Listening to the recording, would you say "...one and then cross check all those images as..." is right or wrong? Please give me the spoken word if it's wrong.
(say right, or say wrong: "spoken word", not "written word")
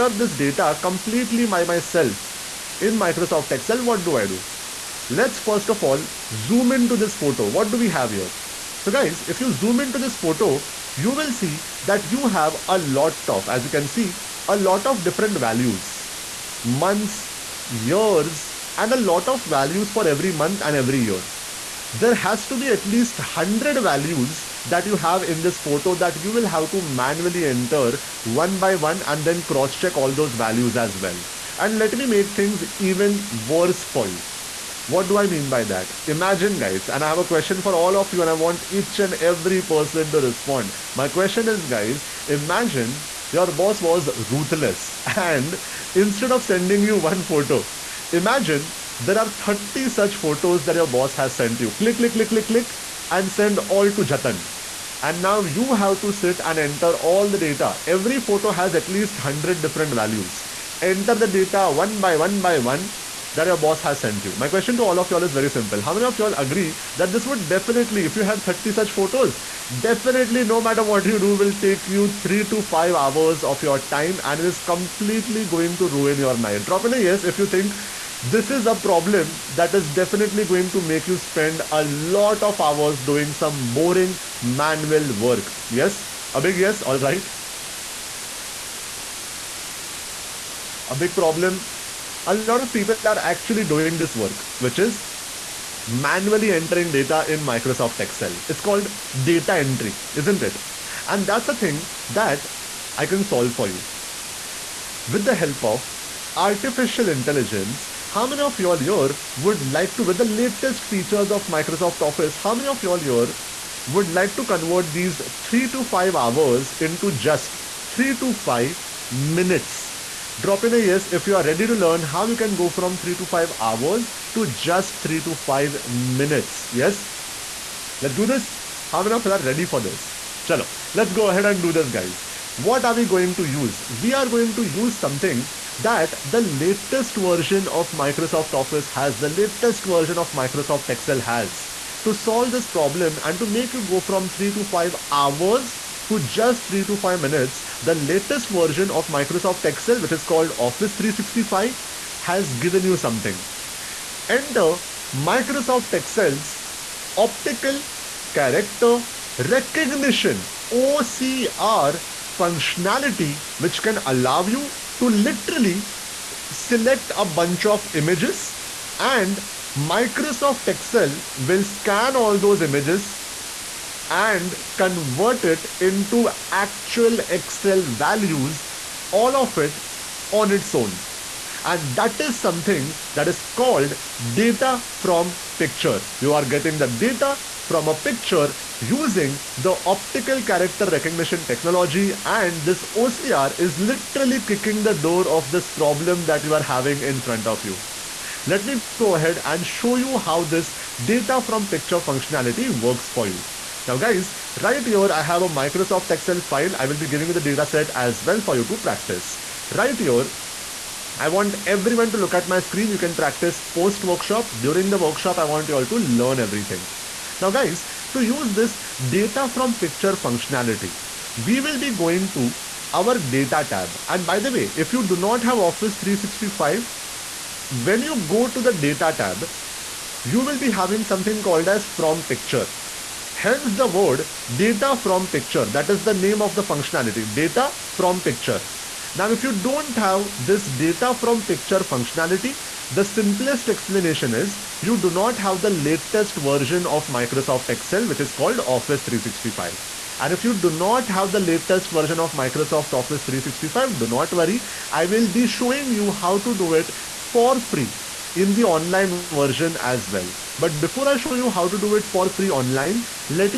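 wrong: "values", not "images".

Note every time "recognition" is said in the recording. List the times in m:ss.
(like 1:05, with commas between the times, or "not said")
2:39, 3:10.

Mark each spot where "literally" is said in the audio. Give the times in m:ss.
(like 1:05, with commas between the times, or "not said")
2:45, 3:13.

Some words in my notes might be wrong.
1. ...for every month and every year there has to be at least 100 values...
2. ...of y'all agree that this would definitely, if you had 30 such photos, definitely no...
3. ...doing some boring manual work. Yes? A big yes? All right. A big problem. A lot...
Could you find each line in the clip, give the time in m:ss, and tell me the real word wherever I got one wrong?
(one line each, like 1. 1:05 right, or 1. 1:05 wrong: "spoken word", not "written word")
1. 0:19 right
2. 1:06 right
3. 1:22 right.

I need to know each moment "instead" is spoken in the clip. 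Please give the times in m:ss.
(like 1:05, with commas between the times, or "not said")
0:45.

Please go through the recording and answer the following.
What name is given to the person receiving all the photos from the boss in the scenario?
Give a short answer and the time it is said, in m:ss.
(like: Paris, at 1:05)
Jatin, at 0:54.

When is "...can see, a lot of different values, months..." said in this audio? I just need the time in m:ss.
0:13.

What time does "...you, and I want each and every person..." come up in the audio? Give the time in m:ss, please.
0:38.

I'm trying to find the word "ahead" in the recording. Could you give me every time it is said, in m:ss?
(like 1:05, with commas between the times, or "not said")
2:11, 3:19.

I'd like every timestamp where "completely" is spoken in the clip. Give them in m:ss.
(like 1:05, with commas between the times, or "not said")
0:00, 1:14.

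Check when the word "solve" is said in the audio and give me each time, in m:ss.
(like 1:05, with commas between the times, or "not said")
1:43, 2:22.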